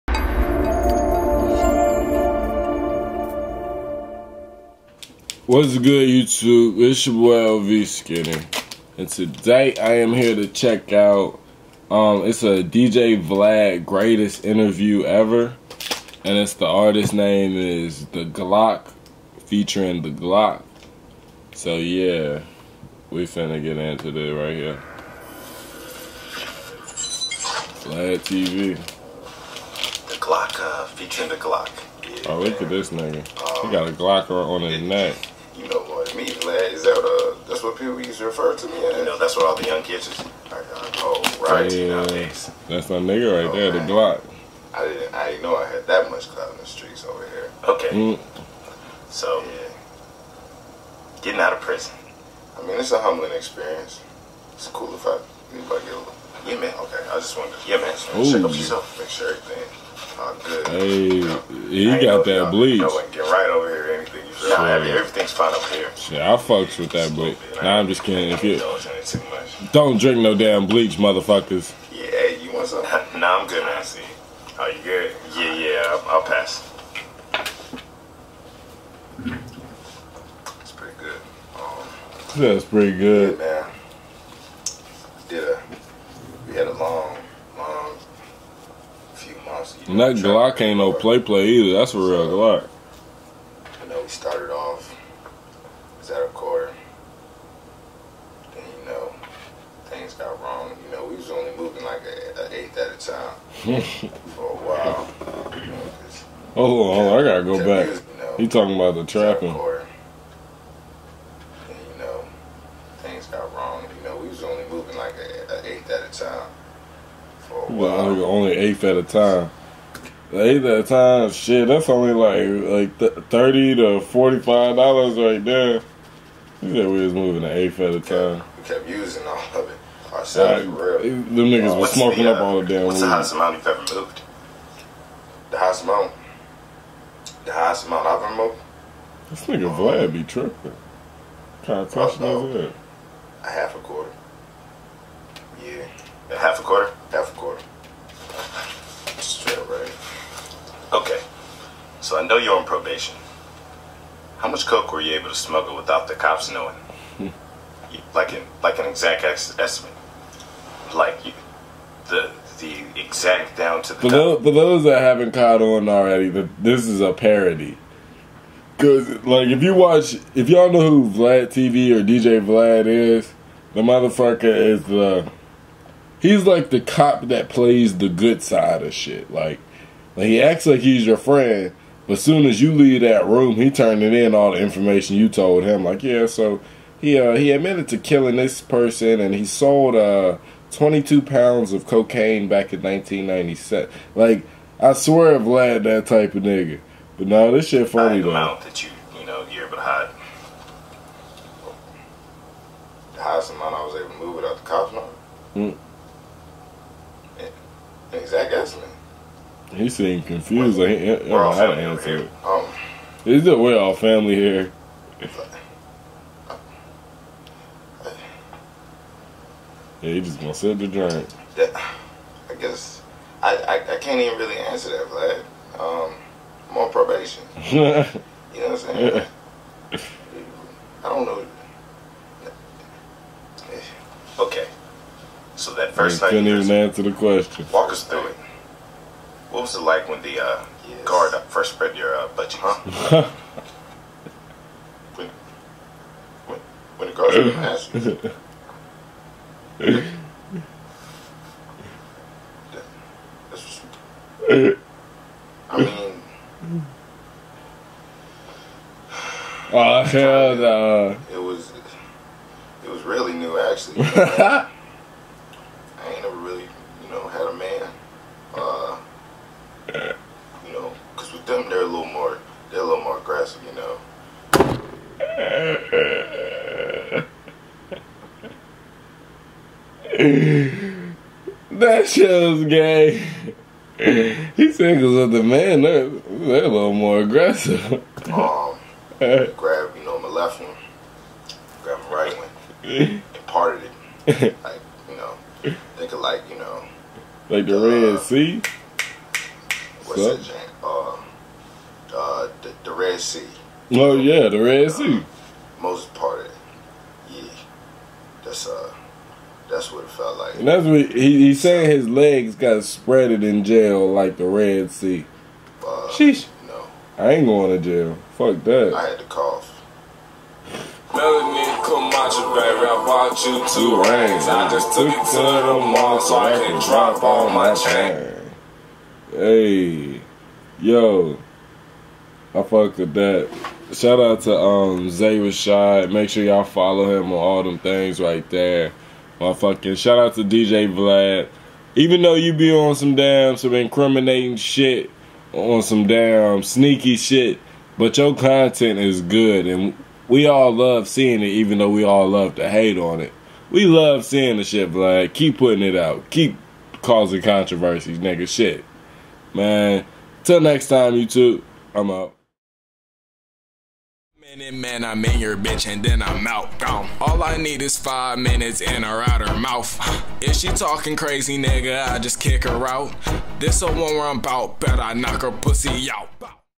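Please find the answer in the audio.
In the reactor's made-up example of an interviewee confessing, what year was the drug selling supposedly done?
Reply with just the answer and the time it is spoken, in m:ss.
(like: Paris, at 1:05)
1997, at 3:12.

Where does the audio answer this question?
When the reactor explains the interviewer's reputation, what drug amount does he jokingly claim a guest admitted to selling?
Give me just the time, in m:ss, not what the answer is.
3:10.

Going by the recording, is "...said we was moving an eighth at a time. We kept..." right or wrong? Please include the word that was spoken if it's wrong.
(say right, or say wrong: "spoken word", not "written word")
right.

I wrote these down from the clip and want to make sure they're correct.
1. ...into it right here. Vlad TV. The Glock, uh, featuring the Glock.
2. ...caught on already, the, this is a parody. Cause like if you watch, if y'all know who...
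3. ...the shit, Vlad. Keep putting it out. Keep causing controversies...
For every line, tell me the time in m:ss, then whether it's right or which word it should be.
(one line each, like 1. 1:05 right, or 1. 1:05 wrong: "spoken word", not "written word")
1. 0:23 right
2. 2:45 right
3. 5:54 right.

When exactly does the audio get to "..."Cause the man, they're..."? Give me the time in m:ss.
4:45.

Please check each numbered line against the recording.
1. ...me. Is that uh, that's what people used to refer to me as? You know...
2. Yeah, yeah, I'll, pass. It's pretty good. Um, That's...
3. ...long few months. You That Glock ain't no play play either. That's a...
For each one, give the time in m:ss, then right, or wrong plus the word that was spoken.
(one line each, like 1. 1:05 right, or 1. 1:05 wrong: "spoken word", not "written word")
1. 0:36 right
2. 1:15 right
3. 1:27 right.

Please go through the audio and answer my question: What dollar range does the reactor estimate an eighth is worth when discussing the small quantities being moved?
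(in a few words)
$30 to $45.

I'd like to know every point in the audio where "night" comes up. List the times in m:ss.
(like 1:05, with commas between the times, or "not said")
3:56.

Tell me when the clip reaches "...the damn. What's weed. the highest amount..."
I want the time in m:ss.
2:12.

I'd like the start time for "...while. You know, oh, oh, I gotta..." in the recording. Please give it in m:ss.
1:44.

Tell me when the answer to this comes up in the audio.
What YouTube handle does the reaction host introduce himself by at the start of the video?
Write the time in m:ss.
0:07.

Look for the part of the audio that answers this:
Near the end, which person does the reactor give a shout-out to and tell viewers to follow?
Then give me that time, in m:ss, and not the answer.
5:35.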